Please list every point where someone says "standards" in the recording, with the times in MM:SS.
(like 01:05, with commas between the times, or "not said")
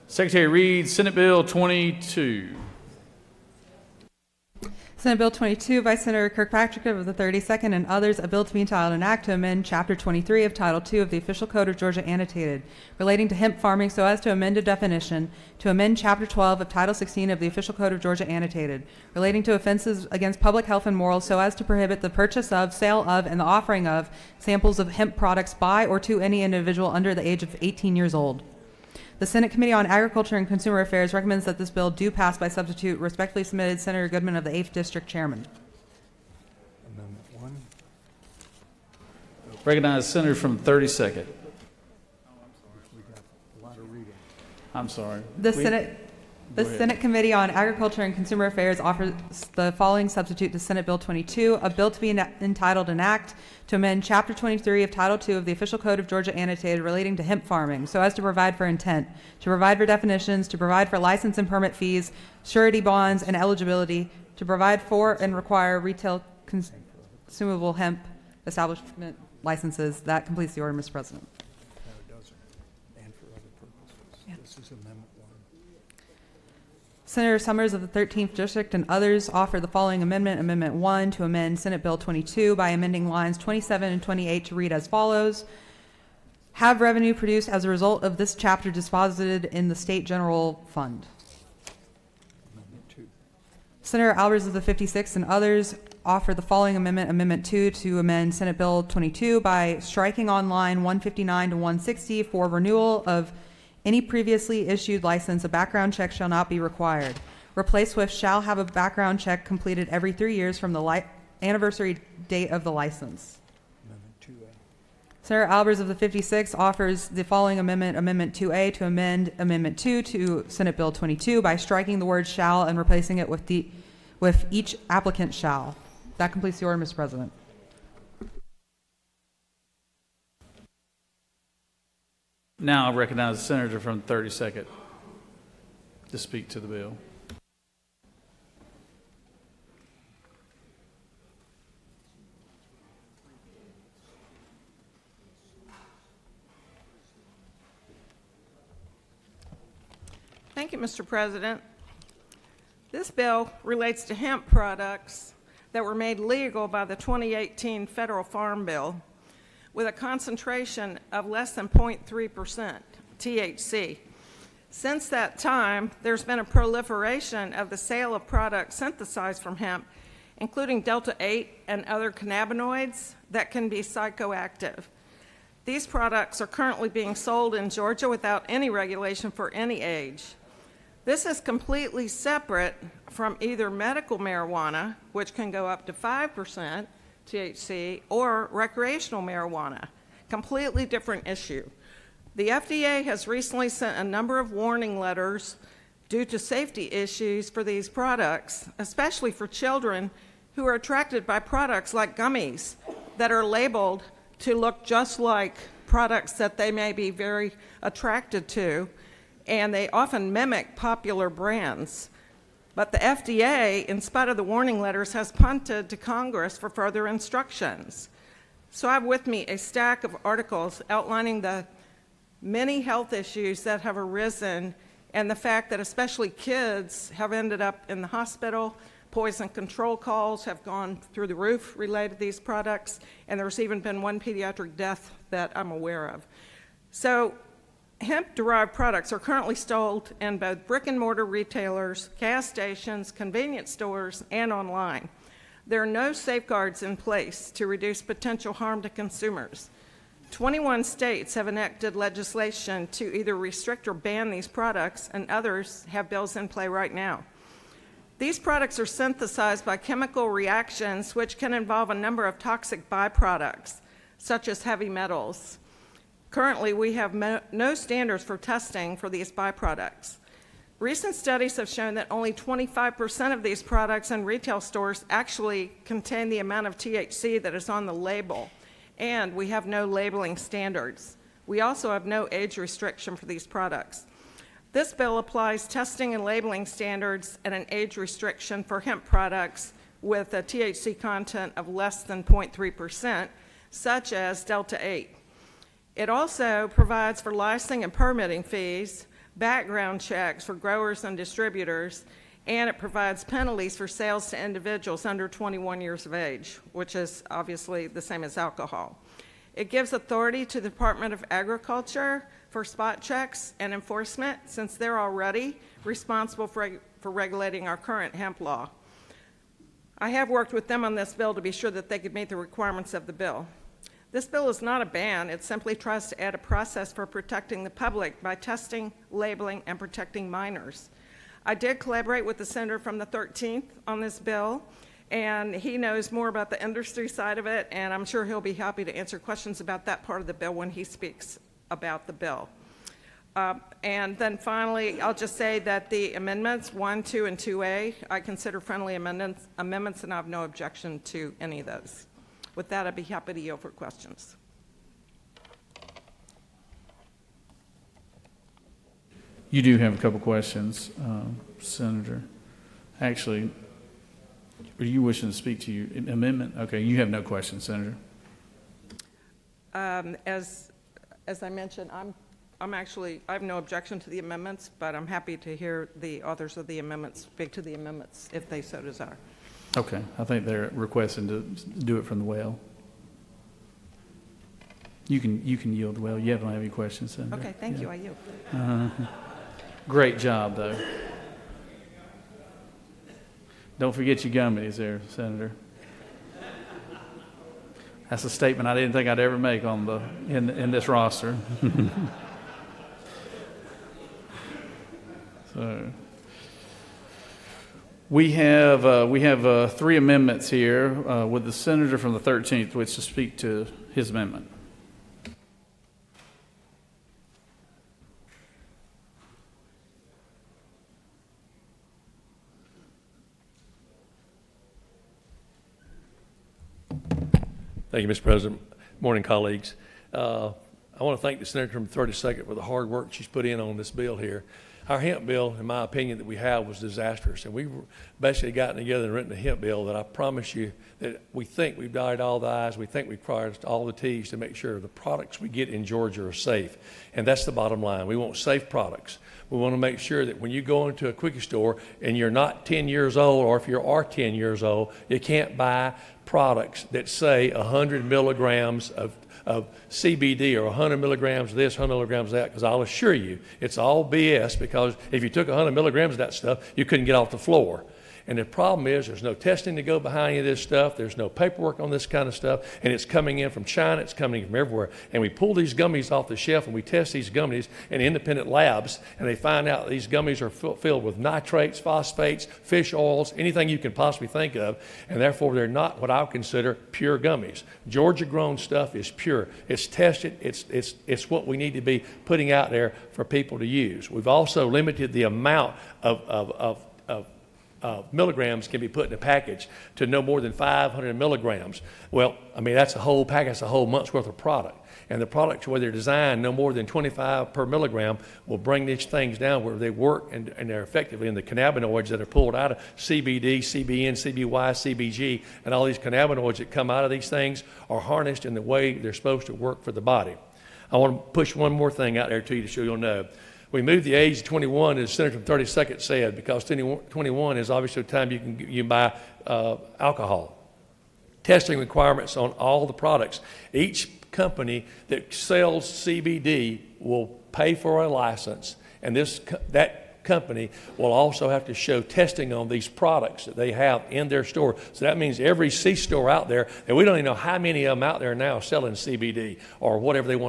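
04:27, 04:40, 04:46.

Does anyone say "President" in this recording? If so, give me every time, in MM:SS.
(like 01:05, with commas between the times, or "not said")
01:10, 02:06, 02:31, 07:08.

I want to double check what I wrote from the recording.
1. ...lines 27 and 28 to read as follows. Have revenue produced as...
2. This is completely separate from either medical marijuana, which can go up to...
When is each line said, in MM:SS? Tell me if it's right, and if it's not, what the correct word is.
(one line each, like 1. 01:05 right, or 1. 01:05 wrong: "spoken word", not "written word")
1. 01:23 right
2. 03:01 right.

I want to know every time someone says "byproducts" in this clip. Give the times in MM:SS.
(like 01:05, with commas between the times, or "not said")
04:22, 04:29.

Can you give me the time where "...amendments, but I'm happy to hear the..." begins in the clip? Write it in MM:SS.
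06:14.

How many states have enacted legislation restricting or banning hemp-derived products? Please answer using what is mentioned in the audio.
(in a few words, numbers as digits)
21.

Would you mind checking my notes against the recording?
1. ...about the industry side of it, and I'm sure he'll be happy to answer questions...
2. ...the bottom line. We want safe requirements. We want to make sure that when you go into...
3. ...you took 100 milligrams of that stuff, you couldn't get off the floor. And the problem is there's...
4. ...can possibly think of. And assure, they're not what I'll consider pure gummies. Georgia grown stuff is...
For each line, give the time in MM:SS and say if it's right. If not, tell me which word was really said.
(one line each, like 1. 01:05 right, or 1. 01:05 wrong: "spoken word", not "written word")
1. 05:36 right
2. 07:27 wrong: "products", not "requirements"
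3. 07:45 right
4. 08:03 wrong: "therefore", not "assure".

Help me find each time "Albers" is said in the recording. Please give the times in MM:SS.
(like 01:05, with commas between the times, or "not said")
01:34, 01:55.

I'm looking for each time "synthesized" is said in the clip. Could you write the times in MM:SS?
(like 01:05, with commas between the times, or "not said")
02:48, 04:18.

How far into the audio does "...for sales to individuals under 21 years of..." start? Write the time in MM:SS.
05:03.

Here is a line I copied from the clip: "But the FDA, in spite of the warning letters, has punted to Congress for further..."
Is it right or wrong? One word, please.
right.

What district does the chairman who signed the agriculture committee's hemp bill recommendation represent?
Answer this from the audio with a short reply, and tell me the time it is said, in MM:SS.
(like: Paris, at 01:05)
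8th, at 00:34.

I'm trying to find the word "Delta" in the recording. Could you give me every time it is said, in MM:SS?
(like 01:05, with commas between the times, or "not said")
02:50, 04:54.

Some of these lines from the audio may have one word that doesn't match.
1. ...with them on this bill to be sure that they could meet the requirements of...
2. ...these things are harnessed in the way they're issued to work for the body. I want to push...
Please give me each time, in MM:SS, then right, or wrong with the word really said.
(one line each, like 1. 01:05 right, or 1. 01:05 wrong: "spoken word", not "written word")
1. 05:20 right
2. 08:37 wrong: "supposed", not "issued".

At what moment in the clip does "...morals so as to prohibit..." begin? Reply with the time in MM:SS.
00:20.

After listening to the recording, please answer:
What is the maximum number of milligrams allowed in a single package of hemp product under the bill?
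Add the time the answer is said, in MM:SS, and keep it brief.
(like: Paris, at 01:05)
500 milligrams, at 08:20.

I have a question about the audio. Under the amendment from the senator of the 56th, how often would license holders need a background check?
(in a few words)
Every three years.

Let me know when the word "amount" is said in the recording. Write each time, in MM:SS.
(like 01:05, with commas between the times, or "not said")
04:36, 08:15.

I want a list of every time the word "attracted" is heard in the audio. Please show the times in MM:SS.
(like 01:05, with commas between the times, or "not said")
03:20, 03:27.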